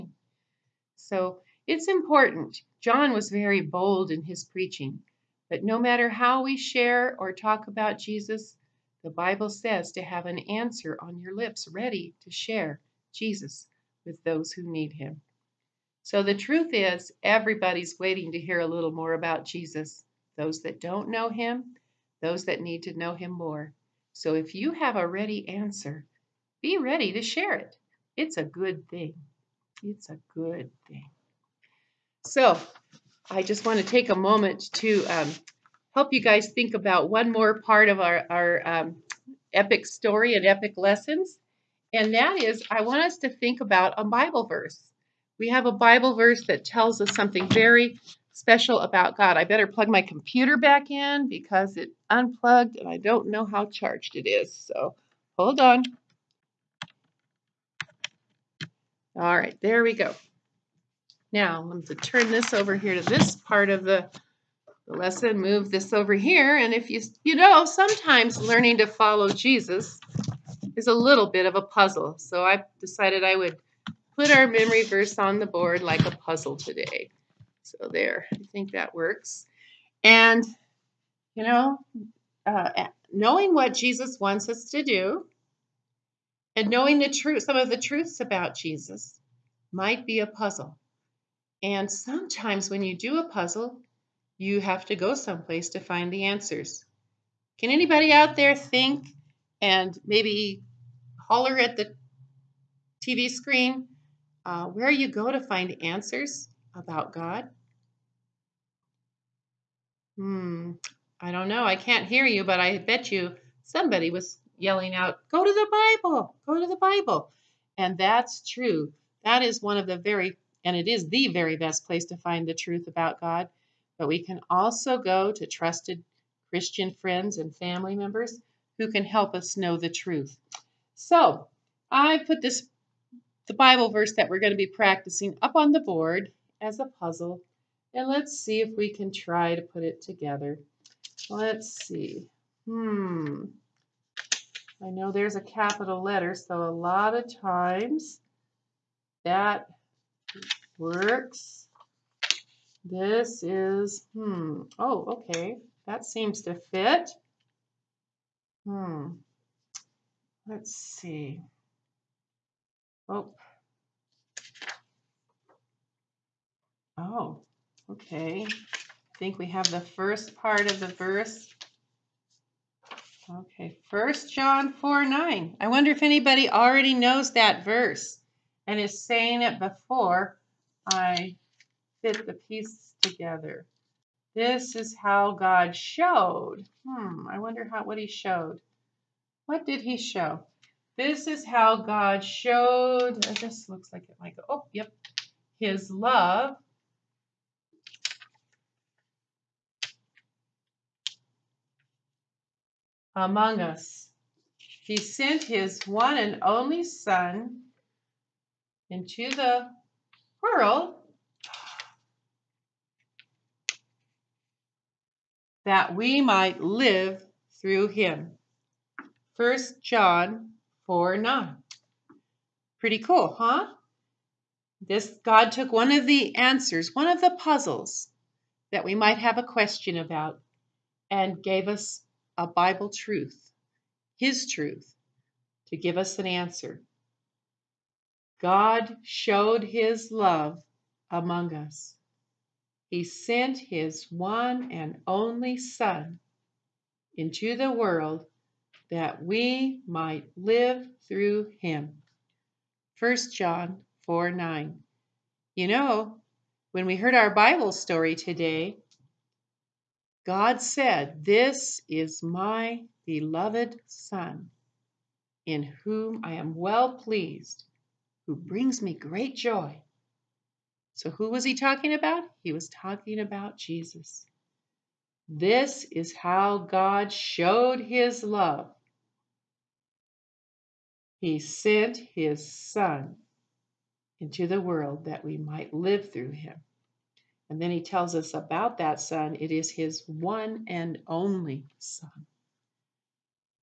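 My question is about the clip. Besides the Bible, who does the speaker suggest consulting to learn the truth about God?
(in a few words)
trusted Christian friends and family.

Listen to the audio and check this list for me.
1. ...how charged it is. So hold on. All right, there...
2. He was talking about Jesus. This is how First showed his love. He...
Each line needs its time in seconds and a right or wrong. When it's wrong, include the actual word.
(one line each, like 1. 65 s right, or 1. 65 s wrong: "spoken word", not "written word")
1. 53 s right
2. 272 s wrong: "God", not "First".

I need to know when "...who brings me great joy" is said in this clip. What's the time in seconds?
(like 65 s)
268 s.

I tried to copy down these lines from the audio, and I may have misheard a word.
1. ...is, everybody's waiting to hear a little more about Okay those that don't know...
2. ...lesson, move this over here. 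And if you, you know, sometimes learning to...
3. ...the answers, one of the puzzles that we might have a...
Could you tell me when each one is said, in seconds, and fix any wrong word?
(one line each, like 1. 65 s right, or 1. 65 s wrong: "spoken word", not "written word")
1. 16 s wrong: "Jesus", not "Okay"
2. 64 s right
3. 226 s right.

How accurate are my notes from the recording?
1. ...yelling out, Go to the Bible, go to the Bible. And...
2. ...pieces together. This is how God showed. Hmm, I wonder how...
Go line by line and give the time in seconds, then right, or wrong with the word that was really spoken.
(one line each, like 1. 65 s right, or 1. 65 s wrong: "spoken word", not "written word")
1. 114 s right
2. 182 s right.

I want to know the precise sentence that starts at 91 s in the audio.
And sometimes when you do a puzzle, you have to go someplace to find the answers.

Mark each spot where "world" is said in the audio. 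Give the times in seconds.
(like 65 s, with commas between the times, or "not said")
210 s, 247 s, 284 s.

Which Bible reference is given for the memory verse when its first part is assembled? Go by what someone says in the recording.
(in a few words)
1 John 4:9.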